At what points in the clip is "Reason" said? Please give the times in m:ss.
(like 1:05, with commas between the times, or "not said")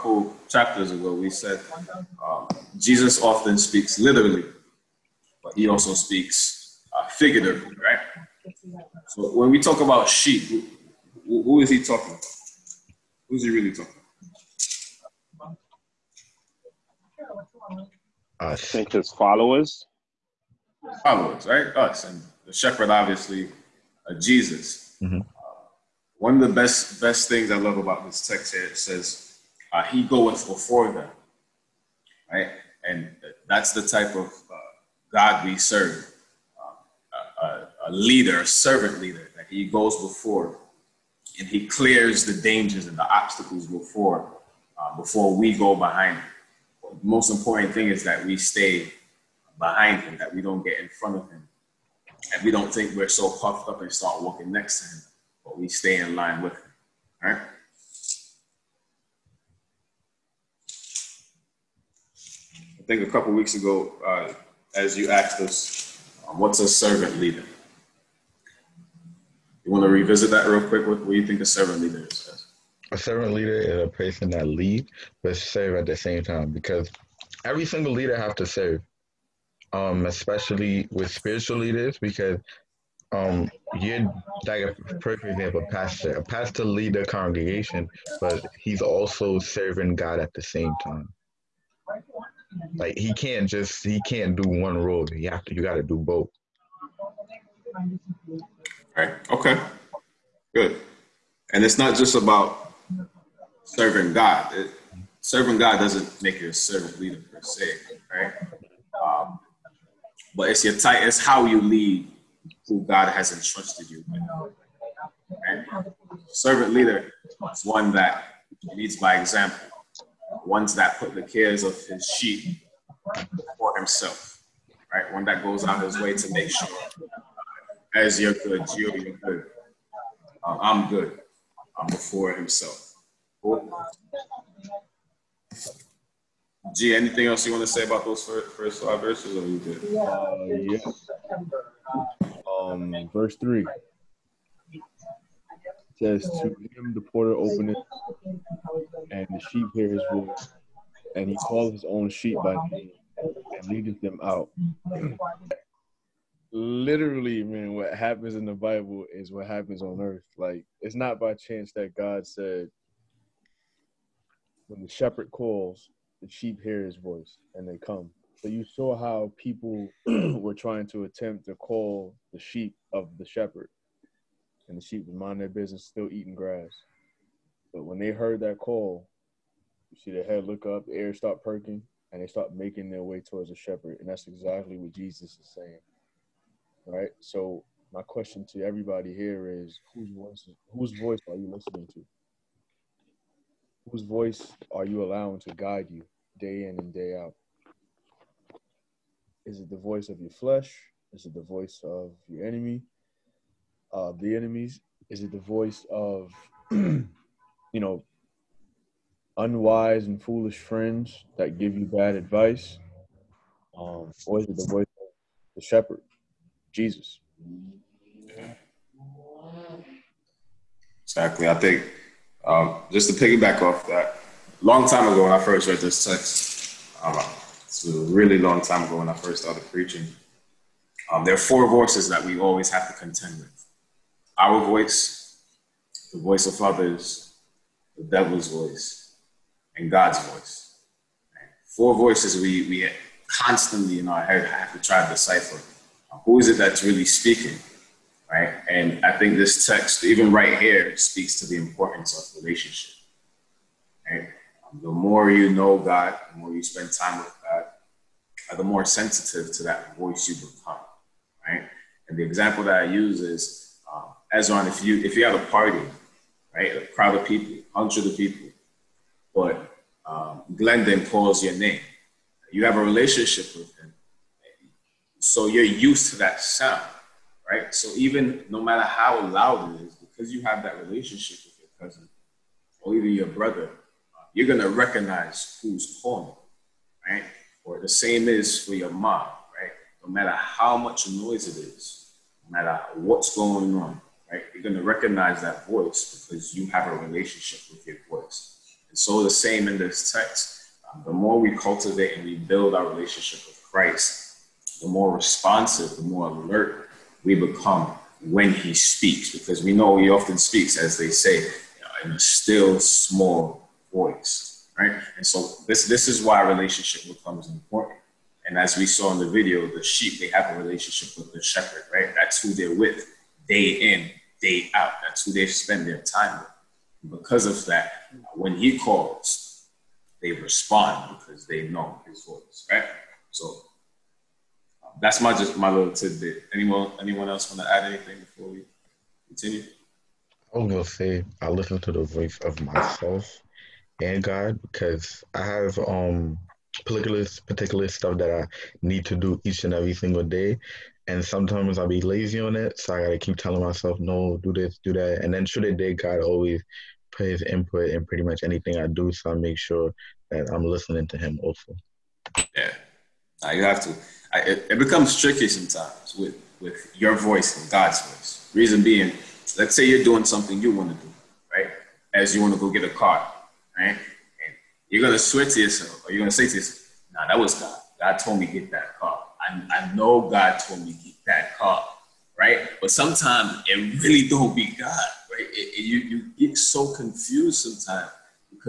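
6:08.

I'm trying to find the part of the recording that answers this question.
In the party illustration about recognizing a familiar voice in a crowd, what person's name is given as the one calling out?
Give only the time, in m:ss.
4:30.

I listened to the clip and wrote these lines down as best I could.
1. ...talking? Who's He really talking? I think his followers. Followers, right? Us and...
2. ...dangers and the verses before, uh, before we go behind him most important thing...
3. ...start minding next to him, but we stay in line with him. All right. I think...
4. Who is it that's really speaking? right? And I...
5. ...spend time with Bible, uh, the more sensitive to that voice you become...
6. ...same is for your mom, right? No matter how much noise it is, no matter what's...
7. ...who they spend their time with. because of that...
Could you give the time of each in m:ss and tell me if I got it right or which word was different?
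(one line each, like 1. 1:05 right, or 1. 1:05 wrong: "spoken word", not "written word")
1. 0:11 right
2. 0:42 wrong: "obstacles", not "verses"
3. 0:53 wrong: "walking", not "minding"
4. 4:06 right
5. 4:16 wrong: "God", not "Bible"
6. 4:47 right
7. 5:25 right.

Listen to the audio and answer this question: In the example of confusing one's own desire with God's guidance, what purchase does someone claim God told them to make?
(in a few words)
A car.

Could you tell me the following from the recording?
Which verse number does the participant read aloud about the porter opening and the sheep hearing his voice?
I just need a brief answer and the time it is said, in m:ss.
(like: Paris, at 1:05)
Verse 3, at 2:23.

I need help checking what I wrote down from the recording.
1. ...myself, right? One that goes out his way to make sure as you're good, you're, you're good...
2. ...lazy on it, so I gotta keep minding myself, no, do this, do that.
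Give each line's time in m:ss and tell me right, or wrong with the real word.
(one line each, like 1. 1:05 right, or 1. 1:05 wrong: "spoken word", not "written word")
1. 2:03 wrong: "himself", not "myself"
2. 5:51 wrong: "telling", not "minding".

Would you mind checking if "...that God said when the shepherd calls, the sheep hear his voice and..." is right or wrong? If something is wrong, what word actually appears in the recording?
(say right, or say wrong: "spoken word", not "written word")
right.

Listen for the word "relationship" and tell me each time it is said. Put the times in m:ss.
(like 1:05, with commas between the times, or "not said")
4:12, 4:32, 4:40, 4:57, 5:02, 5:16, 5:20.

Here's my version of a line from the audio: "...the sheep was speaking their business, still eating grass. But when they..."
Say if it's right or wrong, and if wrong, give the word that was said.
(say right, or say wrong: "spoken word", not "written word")
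wrong: "minding", not "speaking".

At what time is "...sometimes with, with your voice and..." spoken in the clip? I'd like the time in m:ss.
6:05.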